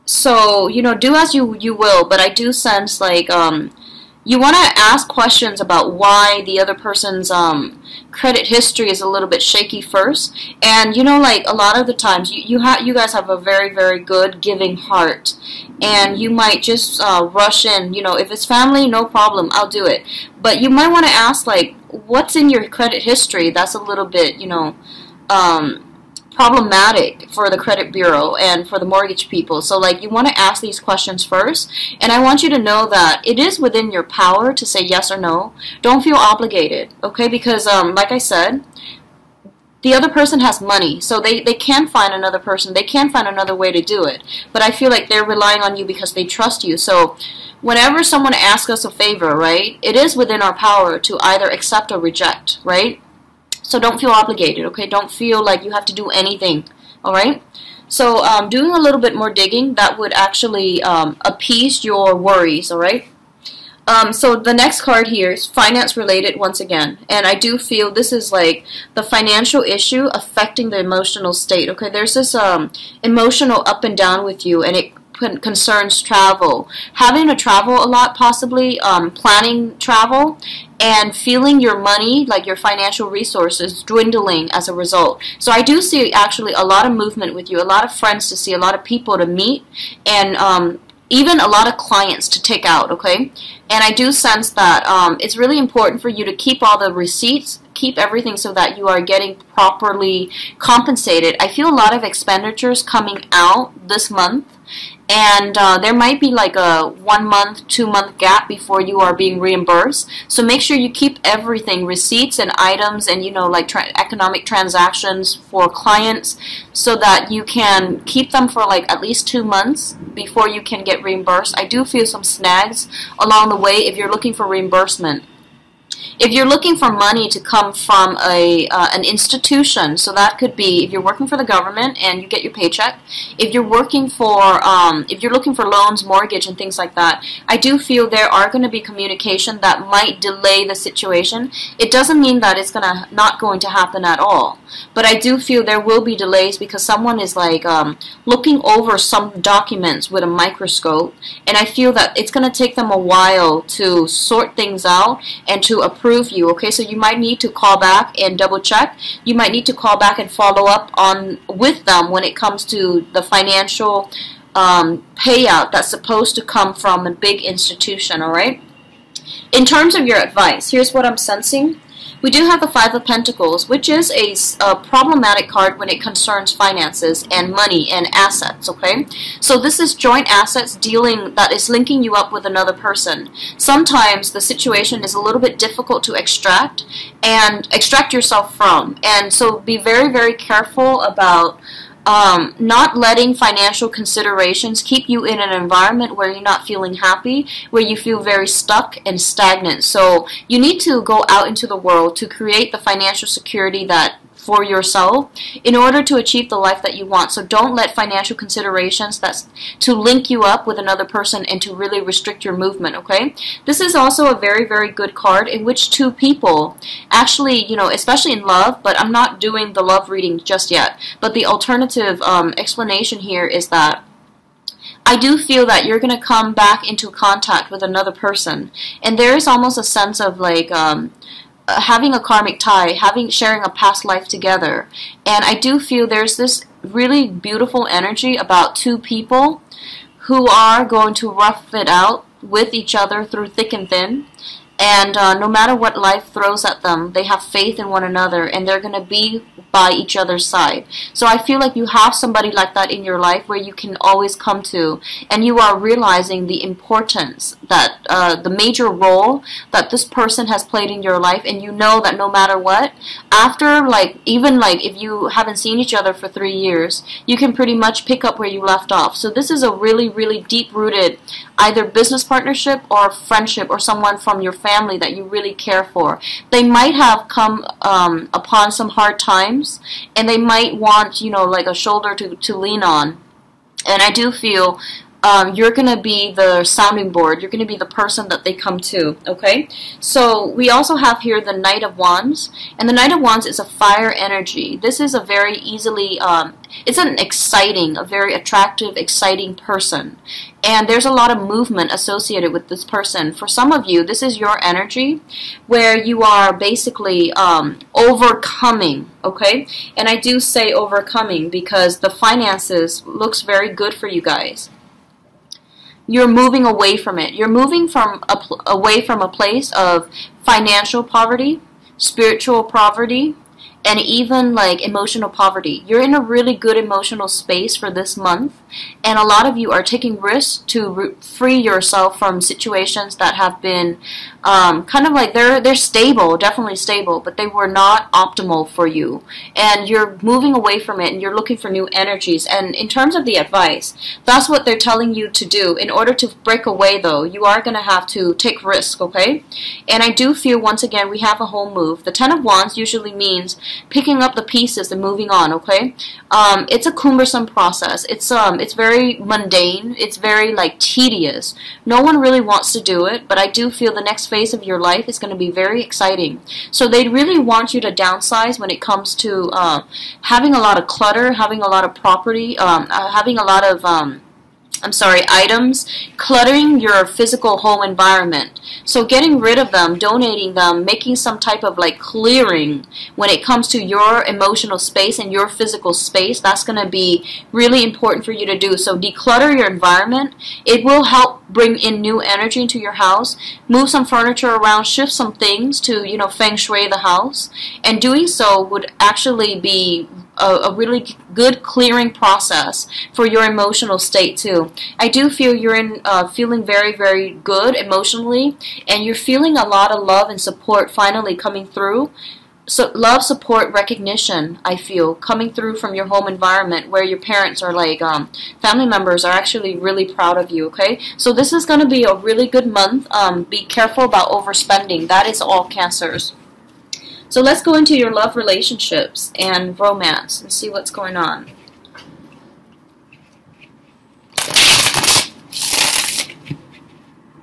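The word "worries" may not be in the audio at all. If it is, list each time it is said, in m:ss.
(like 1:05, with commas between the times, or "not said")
1:02.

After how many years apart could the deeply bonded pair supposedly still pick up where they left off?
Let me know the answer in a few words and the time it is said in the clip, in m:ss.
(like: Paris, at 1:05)
3 years, at 4:26.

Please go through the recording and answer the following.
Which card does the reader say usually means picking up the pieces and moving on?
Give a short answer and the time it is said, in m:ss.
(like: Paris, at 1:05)
Ten of Wands, at 5:52.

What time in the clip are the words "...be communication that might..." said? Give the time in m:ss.
2:18.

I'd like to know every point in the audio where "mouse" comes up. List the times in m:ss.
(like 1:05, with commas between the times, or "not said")
not said.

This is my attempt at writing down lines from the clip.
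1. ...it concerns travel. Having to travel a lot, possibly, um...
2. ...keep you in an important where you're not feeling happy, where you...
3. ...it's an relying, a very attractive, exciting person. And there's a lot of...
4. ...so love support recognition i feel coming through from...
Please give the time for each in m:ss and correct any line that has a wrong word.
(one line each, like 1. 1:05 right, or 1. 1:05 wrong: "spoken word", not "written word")
1. 1:14 right
2. 3:14 wrong: "environment", not "important"
3. 4:56 wrong: "exciting", not "relying"
4. 6:52 right.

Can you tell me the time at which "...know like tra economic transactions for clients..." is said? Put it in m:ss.
1:53.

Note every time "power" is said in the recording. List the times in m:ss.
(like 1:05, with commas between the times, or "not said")
0:34, 0:50.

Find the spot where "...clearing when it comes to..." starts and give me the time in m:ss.
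6:21.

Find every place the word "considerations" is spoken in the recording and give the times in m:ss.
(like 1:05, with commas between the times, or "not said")
3:13, 3:28.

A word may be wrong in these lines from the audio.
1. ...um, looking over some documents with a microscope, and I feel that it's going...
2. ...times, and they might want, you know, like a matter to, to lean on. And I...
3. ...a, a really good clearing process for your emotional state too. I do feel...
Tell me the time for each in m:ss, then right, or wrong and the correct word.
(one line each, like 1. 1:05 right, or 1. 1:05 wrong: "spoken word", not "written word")
1. 2:27 right
2. 4:39 wrong: "shoulder", not "matter"
3. 6:40 right.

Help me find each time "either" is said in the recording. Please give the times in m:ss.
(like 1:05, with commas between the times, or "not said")
0:51, 4:31.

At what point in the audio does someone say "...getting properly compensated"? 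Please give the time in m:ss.
1:39.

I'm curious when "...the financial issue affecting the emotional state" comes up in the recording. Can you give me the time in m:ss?
1:08.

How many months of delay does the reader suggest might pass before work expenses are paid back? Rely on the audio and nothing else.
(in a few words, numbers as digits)
1 or 2 months.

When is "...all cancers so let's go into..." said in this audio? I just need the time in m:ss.
7:05.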